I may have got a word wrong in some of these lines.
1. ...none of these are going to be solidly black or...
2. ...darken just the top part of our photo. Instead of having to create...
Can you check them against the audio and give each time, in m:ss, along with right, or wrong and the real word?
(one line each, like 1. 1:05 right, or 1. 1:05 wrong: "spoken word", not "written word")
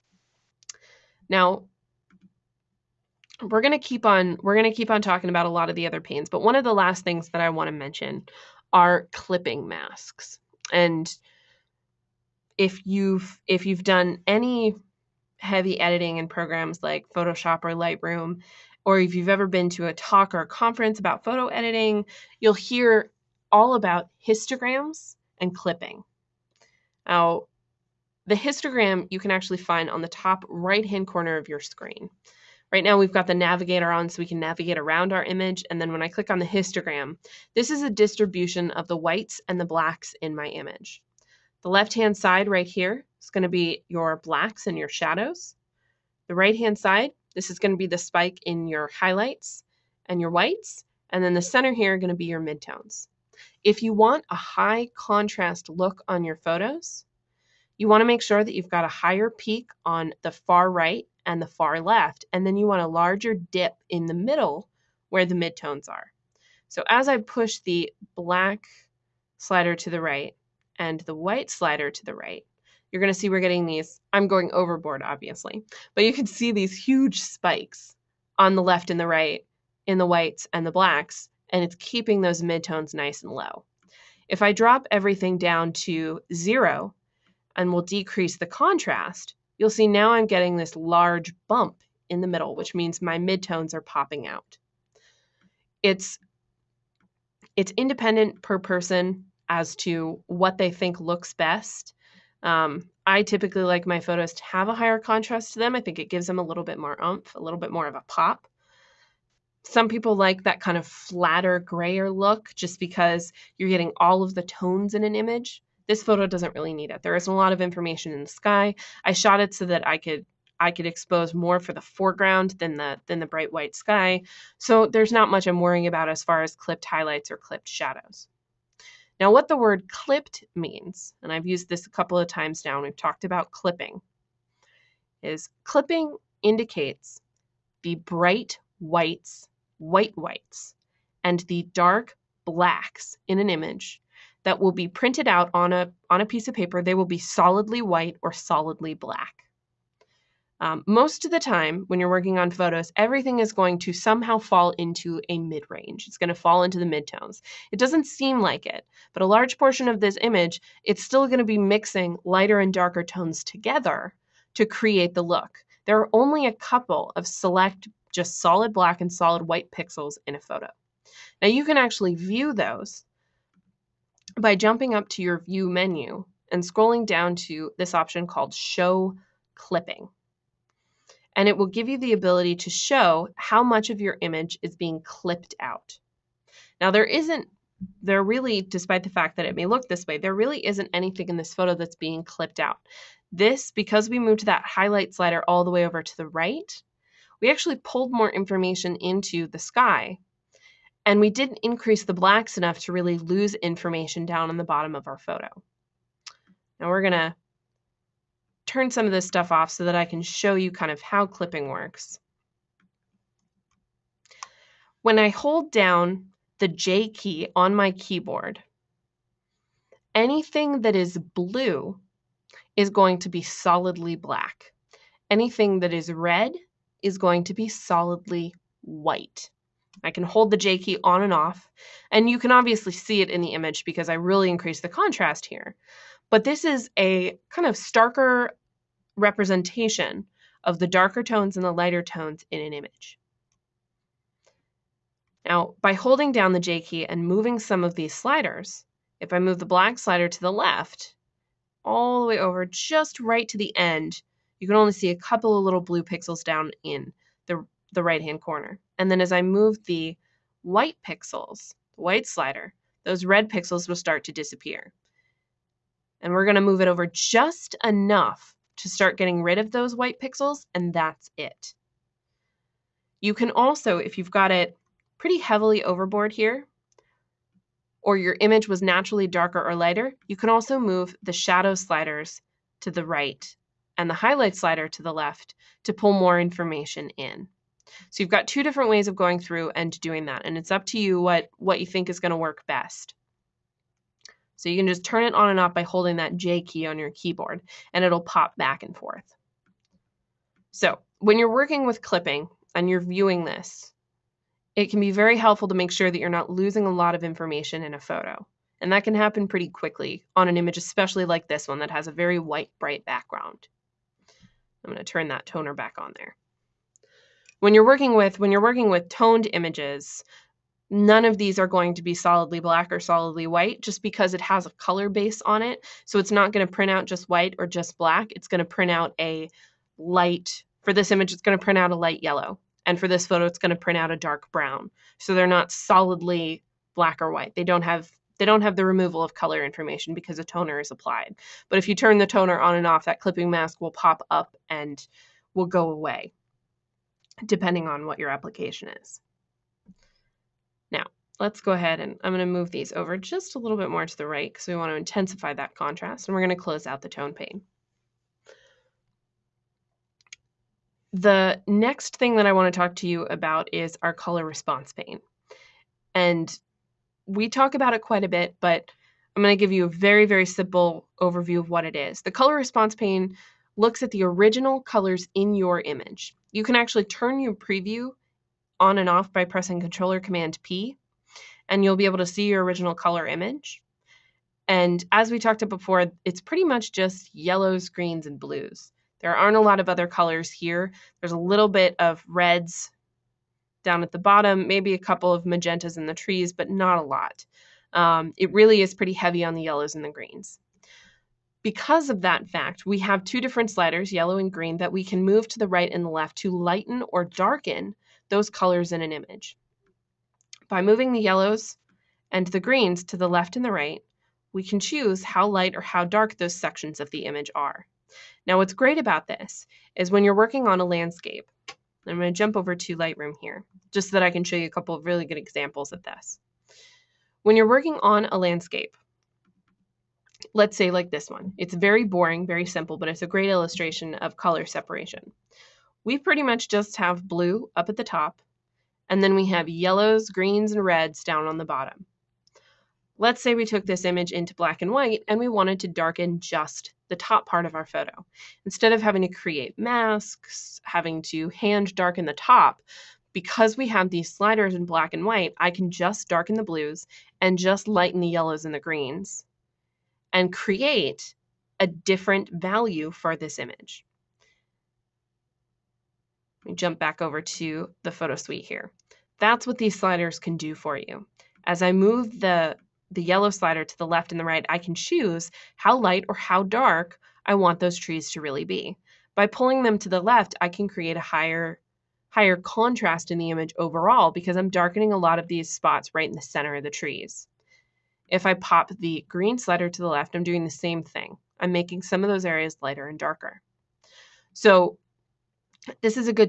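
1. 5:20 right
2. 7:25 right.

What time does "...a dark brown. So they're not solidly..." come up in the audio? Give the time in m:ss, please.
5:34.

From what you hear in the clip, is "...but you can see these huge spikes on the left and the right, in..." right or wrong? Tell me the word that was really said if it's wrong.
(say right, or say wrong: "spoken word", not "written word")
right.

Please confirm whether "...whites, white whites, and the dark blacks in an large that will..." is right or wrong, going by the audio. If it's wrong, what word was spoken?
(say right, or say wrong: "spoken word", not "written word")
wrong: "image", not "large".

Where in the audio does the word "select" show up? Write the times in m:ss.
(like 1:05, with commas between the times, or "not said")
2:47.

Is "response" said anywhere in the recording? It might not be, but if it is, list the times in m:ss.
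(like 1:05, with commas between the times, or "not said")
6:04, 6:12.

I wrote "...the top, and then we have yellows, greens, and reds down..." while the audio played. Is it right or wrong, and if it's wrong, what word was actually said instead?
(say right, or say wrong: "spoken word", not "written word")
right.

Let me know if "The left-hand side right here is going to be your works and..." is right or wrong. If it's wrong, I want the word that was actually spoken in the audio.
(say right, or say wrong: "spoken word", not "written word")
wrong: "blacks", not "works".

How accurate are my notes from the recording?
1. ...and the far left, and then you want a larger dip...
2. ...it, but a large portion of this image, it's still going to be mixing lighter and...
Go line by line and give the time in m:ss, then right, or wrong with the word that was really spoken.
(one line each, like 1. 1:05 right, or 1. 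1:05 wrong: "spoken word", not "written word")
1. 1:01 right
2. 2:38 right.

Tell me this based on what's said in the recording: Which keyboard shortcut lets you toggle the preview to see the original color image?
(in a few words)
Control or Command P.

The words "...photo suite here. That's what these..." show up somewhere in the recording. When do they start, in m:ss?
7:48.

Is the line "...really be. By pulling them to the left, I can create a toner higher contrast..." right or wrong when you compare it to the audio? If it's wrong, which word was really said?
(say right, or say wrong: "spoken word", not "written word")
wrong: "higher", not "toner".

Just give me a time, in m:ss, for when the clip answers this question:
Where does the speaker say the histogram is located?
0:30.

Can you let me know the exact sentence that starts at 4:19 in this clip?
And then as I move the white pixels, the white slider, those red pixels will start to disappear.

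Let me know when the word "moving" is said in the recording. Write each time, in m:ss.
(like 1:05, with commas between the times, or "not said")
4:07, 6:50.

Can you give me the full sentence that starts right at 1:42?
Um, I typically like my photos to have a higher contrast to them.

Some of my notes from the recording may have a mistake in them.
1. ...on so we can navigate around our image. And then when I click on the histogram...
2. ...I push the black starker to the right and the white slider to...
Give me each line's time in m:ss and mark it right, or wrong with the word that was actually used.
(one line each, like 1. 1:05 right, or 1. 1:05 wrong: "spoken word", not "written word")
1. 0:33 right
2. 1:07 wrong: "slider", not "starker".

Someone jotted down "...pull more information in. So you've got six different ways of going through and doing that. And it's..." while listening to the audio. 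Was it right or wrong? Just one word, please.
wrong.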